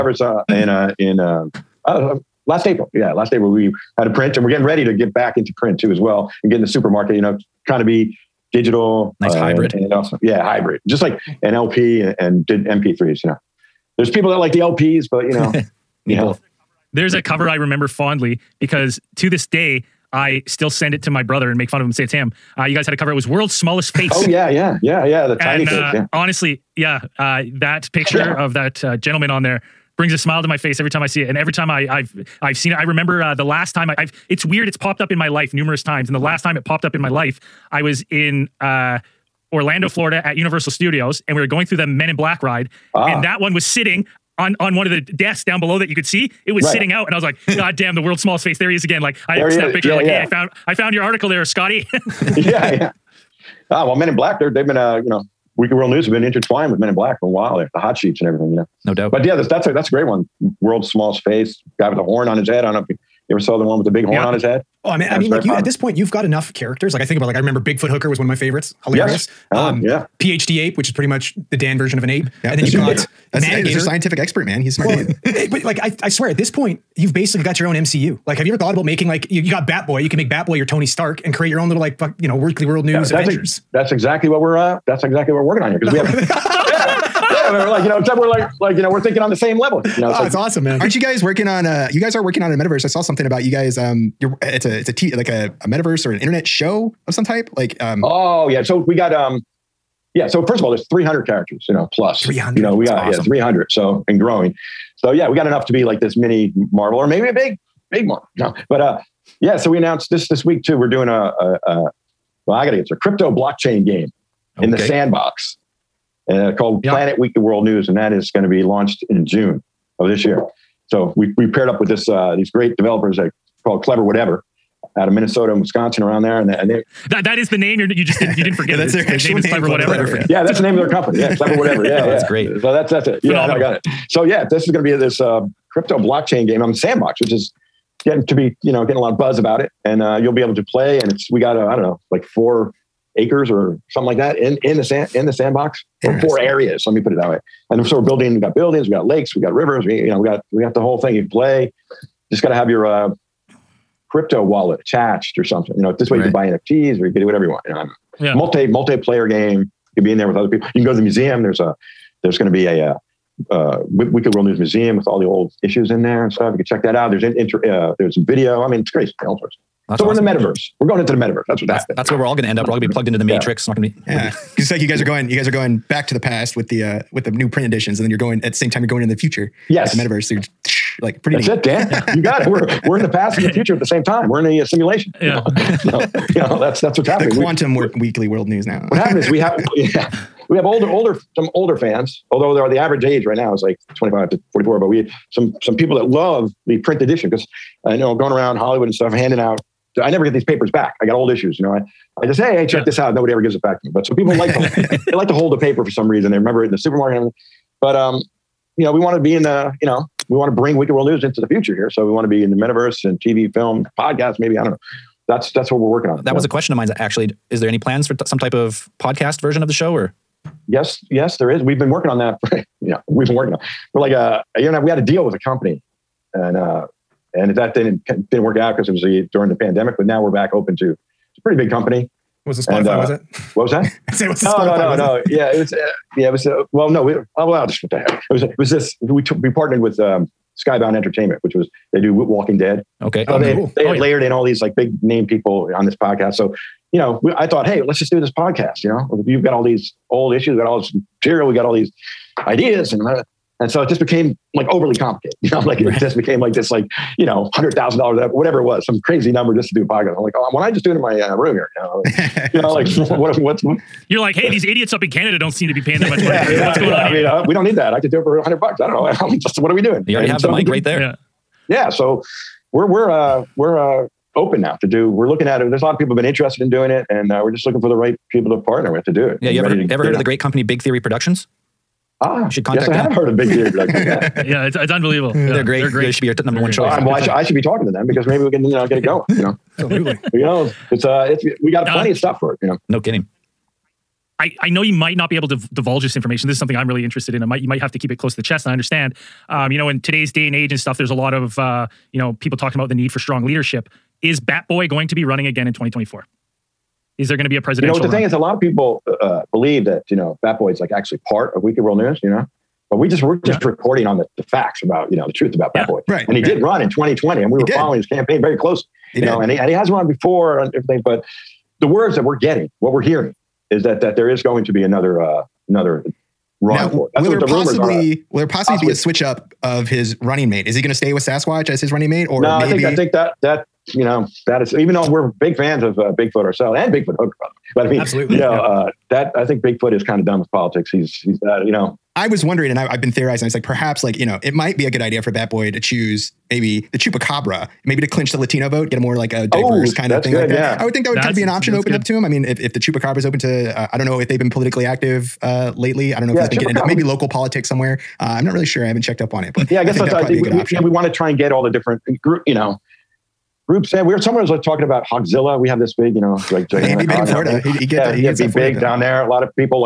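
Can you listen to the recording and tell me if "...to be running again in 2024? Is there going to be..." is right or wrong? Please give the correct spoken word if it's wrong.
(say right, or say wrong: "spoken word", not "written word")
right.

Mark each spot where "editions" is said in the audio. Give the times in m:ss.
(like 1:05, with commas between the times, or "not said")
2:57, 3:17.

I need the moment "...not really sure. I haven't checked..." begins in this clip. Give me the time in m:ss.
5:58.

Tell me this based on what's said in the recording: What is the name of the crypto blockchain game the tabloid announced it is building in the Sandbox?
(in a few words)
Planet Weekly World News.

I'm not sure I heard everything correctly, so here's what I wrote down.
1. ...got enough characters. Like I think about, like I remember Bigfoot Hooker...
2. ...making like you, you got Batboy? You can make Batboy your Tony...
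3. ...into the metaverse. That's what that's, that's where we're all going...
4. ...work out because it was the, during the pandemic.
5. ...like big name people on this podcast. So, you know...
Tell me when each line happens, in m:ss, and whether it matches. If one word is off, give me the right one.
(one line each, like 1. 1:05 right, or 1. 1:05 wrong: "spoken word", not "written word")
1. 1:06 right
2. 1:18 right
3. 2:50 right
4. 3:48 right
5. 4:04 right.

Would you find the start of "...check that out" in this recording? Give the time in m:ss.
2:46.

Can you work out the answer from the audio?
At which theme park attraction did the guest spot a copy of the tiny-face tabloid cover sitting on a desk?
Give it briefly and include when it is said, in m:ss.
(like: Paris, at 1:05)
Men in Black ride, at 0:41.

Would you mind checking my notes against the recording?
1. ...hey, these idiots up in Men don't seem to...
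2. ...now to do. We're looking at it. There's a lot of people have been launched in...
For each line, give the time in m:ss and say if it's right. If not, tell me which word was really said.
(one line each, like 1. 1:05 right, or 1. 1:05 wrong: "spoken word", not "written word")
1. 4:24 wrong: "Canada", not "Men"
2. 4:34 wrong: "interested", not "launched".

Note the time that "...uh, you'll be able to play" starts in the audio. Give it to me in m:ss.
2:20.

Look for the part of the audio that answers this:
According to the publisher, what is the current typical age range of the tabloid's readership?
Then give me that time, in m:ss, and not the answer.
3:13.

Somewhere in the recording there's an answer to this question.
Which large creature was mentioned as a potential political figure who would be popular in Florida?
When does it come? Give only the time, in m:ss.
6:05.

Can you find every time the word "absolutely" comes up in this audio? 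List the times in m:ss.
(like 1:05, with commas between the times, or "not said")
4:49, 5:37.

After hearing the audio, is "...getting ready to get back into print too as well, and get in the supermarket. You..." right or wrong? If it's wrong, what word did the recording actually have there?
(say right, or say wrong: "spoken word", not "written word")
right.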